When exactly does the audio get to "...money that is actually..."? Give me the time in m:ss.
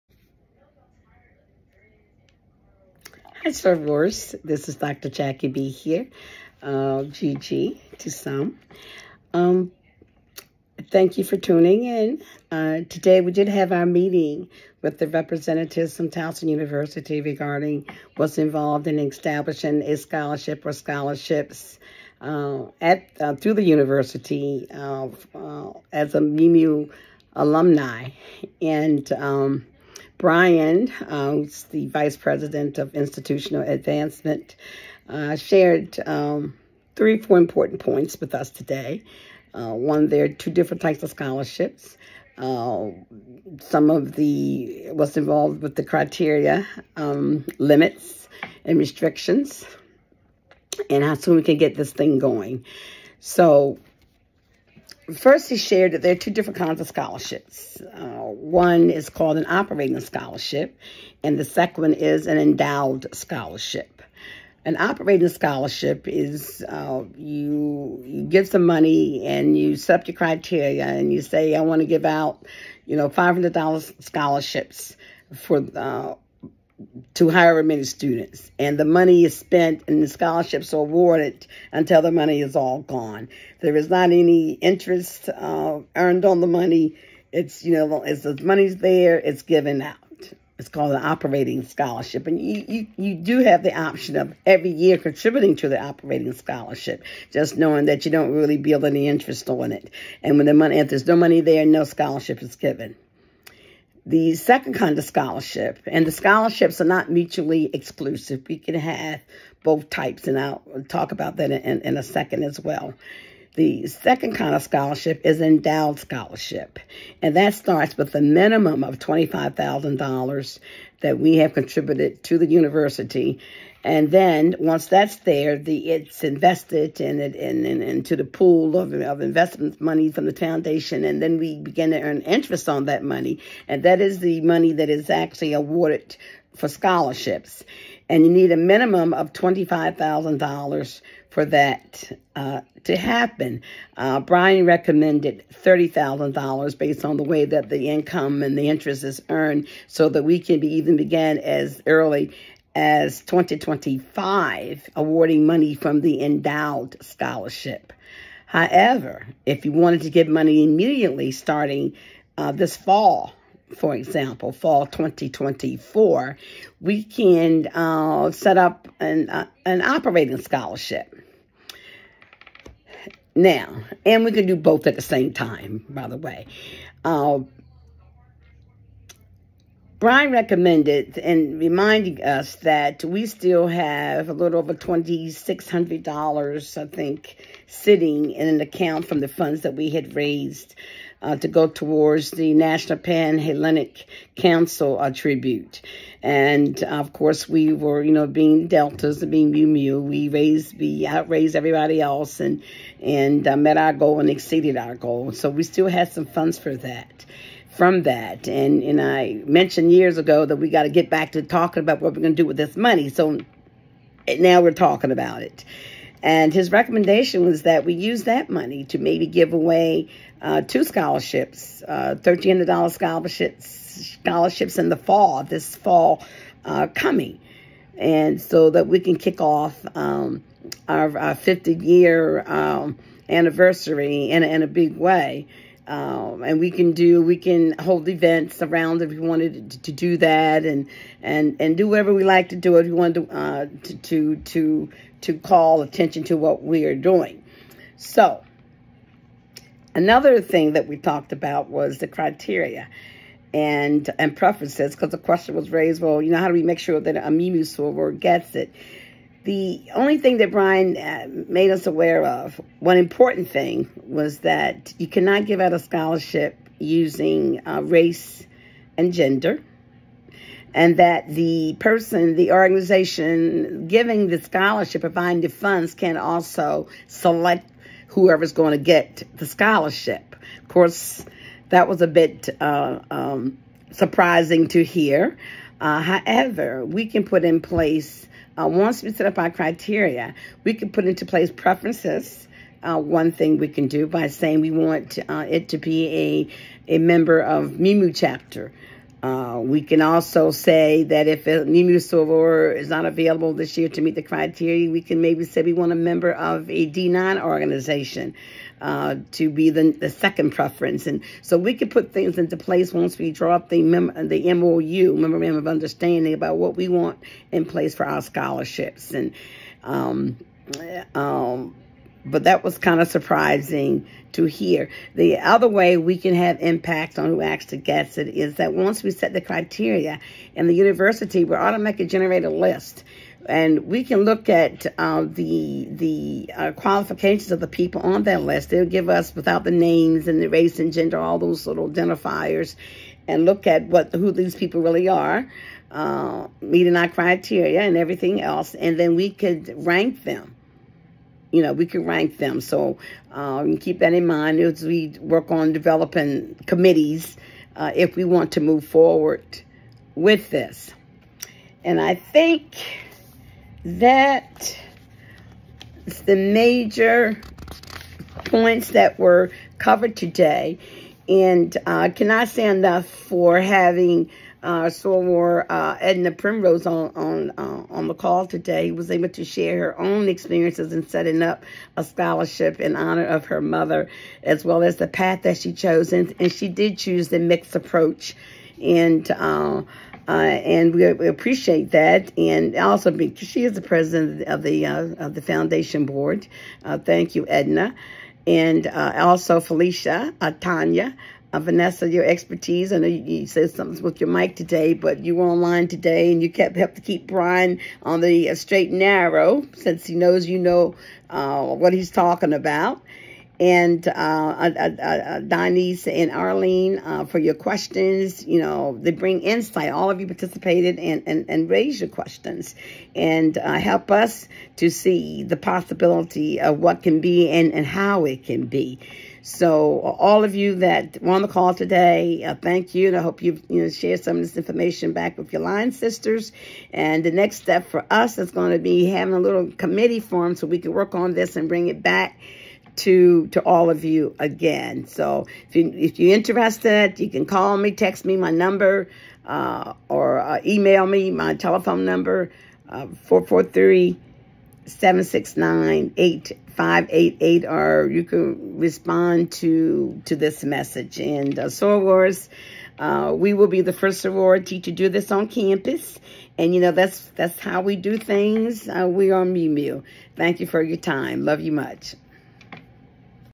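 2:14.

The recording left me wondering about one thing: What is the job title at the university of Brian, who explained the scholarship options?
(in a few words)
Vice President of Institutional Advancement.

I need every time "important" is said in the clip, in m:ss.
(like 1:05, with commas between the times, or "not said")
0:37, 4:22.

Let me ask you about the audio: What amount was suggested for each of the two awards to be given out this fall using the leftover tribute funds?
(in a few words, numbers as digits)
$1,300.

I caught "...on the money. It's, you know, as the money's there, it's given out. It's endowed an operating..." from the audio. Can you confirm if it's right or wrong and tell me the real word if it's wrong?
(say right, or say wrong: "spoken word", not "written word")
wrong: "called", not "endowed".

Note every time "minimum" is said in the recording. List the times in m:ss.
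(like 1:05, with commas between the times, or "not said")
1:58, 2:18.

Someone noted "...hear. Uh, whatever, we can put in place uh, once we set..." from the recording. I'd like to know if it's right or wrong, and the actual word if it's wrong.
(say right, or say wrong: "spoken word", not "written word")
wrong: "however", not "whatever".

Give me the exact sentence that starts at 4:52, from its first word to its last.
Uh, one thing we can do by saying we want uh, it to be a, a member of Mu Mu chapter.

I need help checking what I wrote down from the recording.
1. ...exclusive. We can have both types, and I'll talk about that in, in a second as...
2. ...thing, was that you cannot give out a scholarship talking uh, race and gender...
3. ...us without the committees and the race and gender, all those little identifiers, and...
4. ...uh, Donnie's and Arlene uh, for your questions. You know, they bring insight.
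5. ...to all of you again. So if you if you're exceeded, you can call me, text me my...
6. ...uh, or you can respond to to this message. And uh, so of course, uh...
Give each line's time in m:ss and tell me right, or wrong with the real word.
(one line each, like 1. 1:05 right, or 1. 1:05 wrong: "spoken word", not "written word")
1. 1:47 right
2. 4:23 wrong: "using", not "talking"
3. 5:39 wrong: "names", not "committees"
4. 6:54 right
5. 7:23 wrong: "interested", not "exceeded"
6. 7:37 right.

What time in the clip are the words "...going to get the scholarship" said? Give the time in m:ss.
4:38.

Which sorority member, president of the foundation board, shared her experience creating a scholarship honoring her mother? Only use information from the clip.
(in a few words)
Edna Primrose.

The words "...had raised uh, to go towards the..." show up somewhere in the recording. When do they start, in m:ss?
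3:09.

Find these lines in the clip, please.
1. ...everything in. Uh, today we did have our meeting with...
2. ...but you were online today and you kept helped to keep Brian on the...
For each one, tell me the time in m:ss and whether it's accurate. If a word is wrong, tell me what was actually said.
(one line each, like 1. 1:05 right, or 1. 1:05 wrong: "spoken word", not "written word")
1. 0:11 wrong: "tuning", not "everything"
2. 6:44 right.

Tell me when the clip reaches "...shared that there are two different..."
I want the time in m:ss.
0:55.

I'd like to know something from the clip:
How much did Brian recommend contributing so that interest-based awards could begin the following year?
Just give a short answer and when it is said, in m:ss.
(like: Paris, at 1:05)
$30,000, at 2:25.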